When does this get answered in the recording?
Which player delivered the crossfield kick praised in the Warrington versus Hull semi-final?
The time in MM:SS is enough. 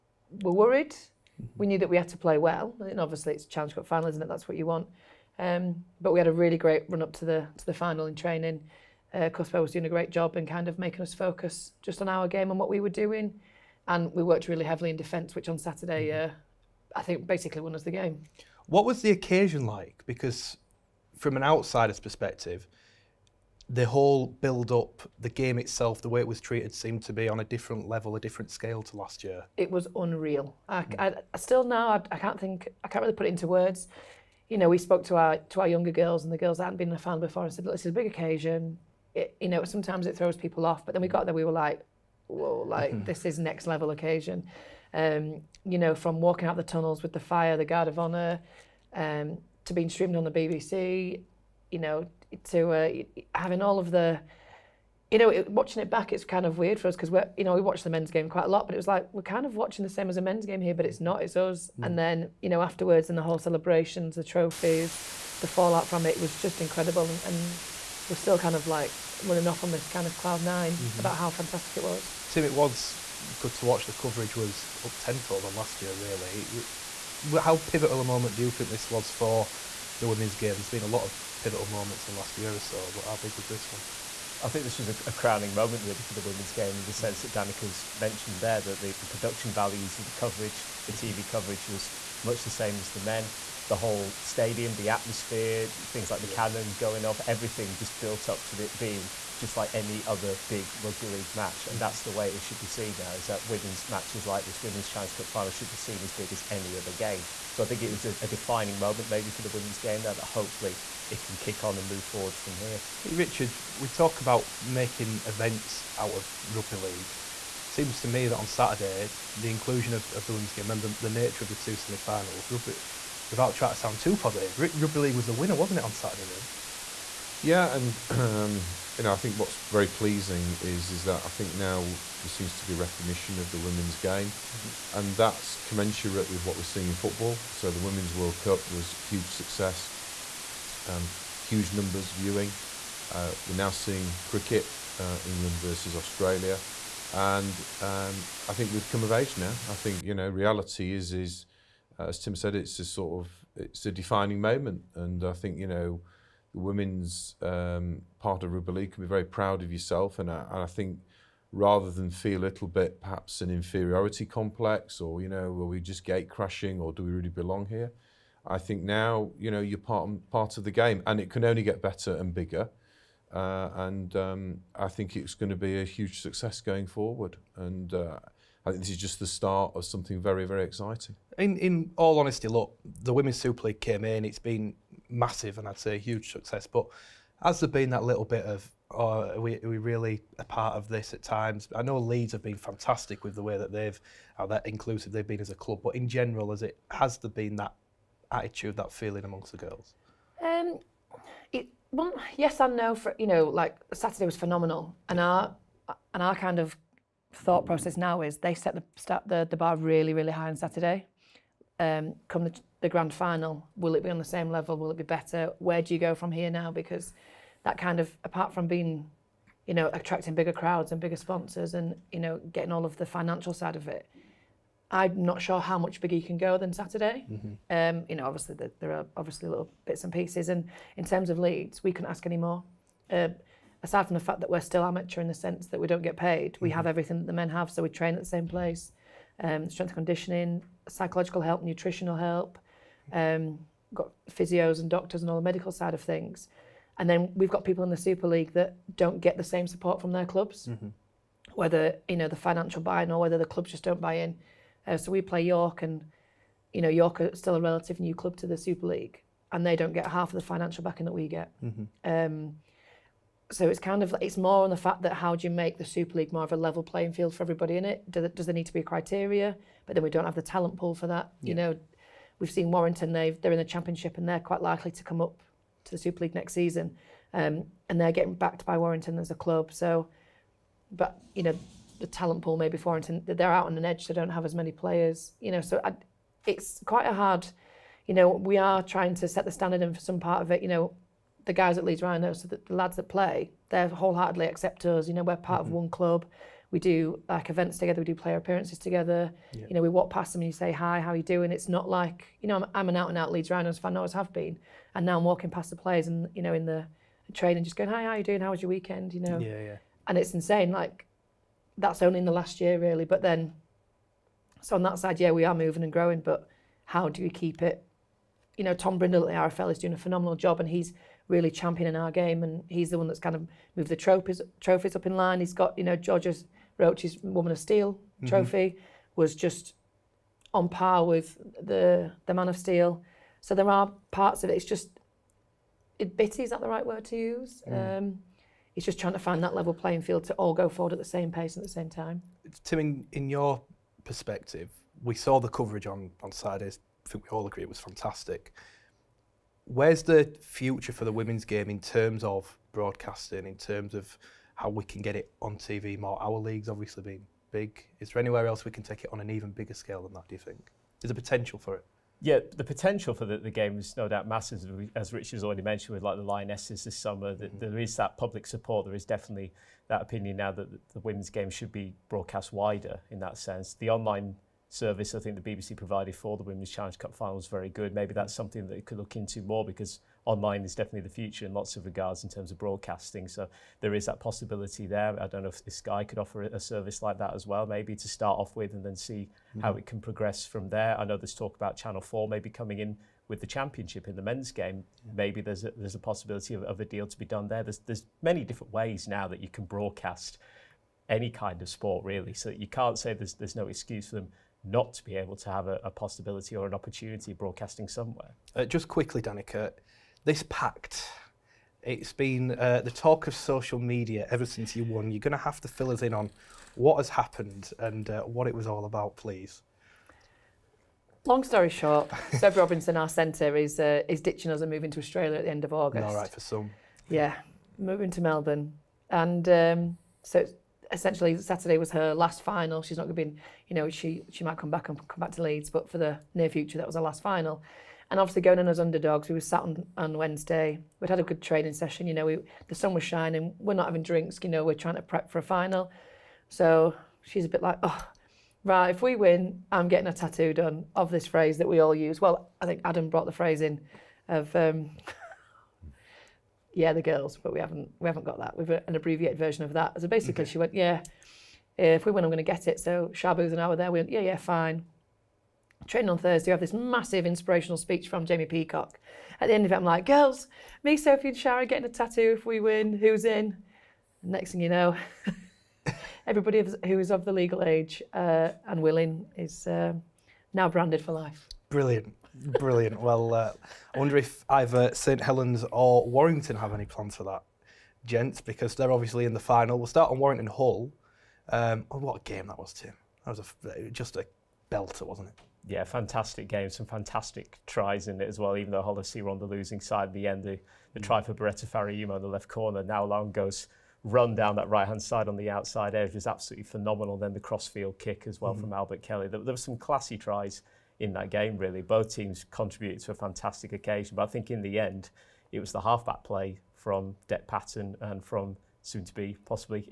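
08:28.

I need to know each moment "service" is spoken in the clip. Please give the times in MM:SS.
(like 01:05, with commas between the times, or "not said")
06:14, 06:26.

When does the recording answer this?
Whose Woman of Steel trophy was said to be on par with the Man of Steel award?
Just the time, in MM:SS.
05:25.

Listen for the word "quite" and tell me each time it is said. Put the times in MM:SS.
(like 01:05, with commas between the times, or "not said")
00:58, 04:34, 04:46.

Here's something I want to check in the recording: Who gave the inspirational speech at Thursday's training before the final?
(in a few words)
Jamie Peacock.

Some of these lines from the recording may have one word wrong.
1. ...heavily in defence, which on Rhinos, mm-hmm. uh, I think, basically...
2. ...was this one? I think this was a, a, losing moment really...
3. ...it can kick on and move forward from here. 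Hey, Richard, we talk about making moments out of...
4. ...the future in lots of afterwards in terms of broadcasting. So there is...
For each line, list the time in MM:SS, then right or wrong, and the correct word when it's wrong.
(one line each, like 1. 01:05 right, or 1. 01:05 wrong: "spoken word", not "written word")
1. 00:14 wrong: "Saturday", not "Rhinos"
2. 01:23 wrong: "crowning", not "losing"
3. 01:51 wrong: "events", not "moments"
4. 06:21 wrong: "regards", not "afterwards".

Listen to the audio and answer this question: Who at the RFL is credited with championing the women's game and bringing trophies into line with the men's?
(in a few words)
Tom Brindle.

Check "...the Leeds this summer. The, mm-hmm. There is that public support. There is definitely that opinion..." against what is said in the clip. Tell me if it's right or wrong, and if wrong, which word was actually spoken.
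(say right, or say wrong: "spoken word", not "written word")
wrong: "Lionesses", not "Leeds".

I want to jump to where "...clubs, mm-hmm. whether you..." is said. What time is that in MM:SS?
04:10.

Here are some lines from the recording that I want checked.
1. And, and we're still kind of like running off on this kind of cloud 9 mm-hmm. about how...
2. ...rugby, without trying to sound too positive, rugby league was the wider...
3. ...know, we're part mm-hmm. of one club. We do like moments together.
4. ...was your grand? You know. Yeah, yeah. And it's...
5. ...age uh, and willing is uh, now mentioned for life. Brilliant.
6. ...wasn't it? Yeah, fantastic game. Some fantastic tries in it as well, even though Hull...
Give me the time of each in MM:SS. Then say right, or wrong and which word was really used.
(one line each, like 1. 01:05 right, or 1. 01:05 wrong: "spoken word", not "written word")
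1. 01:07 right
2. 02:02 wrong: "winner", not "wider"
3. 04:55 wrong: "events", not "moments"
4. 05:08 wrong: "weekend", not "grand"
5. 07:57 wrong: "branded", not "mentioned"
6. 08:15 right.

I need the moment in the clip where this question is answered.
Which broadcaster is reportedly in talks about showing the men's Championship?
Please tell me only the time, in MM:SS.
06:31.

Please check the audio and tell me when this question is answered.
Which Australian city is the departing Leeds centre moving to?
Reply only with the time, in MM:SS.
07:08.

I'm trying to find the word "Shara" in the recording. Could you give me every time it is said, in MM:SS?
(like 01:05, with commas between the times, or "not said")
07:51.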